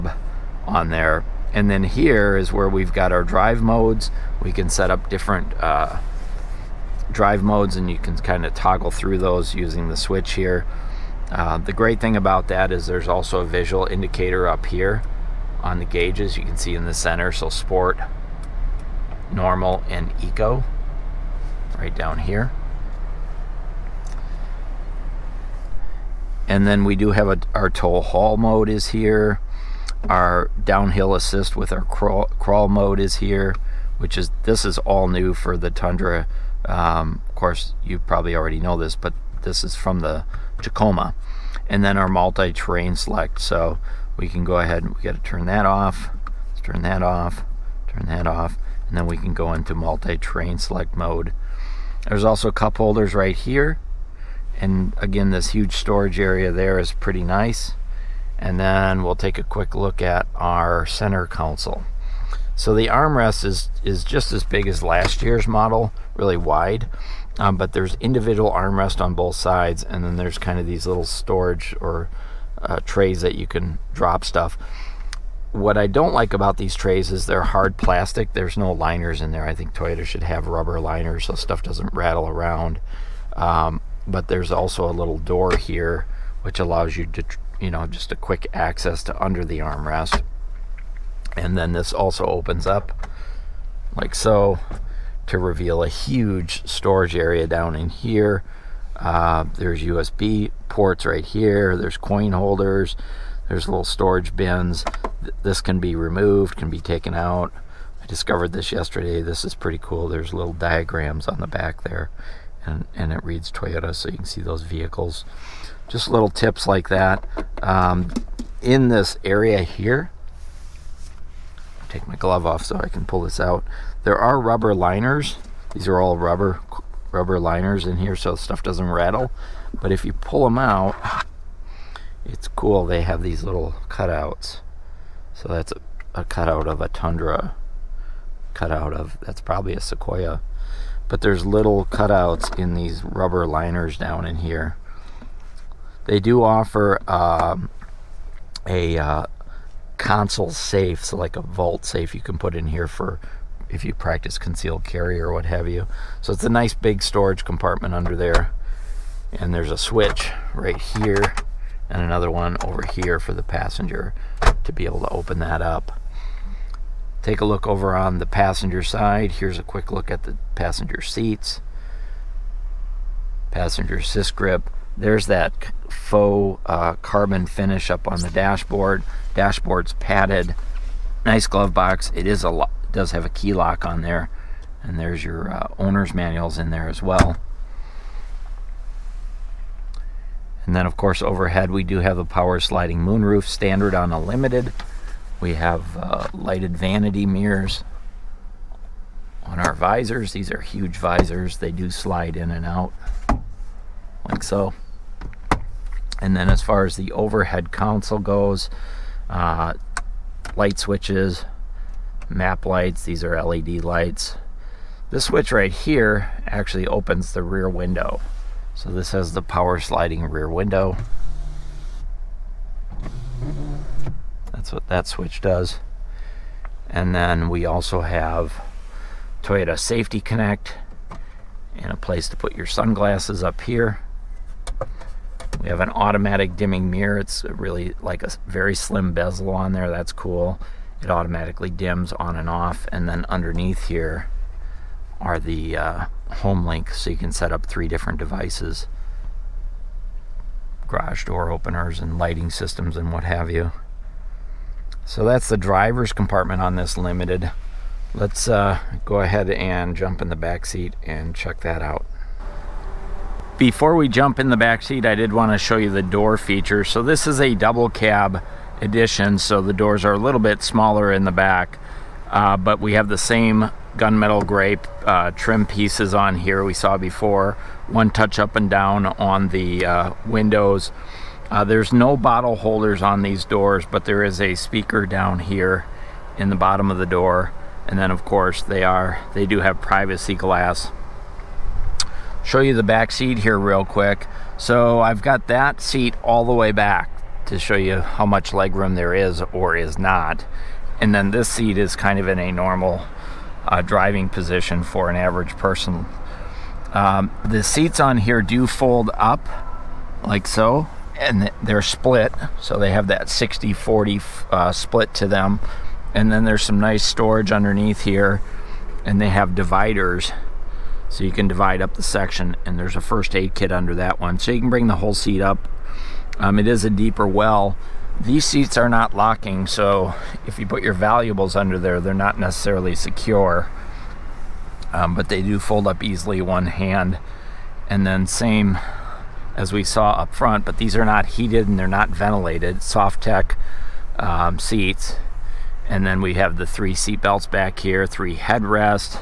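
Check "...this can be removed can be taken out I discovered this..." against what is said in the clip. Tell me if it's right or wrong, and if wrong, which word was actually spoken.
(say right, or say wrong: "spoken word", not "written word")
right.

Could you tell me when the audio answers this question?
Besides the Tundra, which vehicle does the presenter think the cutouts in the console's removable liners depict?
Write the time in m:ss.
2:19.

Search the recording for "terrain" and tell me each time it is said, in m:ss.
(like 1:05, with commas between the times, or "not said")
0:42, 0:49.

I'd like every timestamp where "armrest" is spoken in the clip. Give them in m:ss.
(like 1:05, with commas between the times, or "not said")
1:02, 1:08, 1:29.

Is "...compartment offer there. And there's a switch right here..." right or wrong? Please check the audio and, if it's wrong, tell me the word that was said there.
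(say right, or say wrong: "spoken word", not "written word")
wrong: "under", not "offer".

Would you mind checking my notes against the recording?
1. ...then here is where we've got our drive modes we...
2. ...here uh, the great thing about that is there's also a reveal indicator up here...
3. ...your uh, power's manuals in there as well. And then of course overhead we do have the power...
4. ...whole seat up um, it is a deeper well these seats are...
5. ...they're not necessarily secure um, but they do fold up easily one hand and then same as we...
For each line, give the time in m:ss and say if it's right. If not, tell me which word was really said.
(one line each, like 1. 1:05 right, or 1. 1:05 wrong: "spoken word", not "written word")
1. 0:01 right
2. 0:10 wrong: "visual", not "reveal"
3. 3:05 wrong: "owner", not "power"
4. 5:24 right
5. 5:31 right.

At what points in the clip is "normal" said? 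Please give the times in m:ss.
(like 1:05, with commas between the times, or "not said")
0:19, 5:02.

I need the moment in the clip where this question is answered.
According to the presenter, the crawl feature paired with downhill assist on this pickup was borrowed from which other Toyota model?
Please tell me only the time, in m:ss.
0:40.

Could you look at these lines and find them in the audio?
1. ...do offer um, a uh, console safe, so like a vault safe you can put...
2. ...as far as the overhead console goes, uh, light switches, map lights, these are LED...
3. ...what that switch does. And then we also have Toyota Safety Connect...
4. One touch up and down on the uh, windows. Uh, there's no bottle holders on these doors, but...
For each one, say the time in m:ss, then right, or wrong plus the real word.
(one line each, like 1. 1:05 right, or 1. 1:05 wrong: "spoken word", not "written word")
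1. 2:26 right
2. 3:26 right
3. 3:44 right
4. 4:37 right.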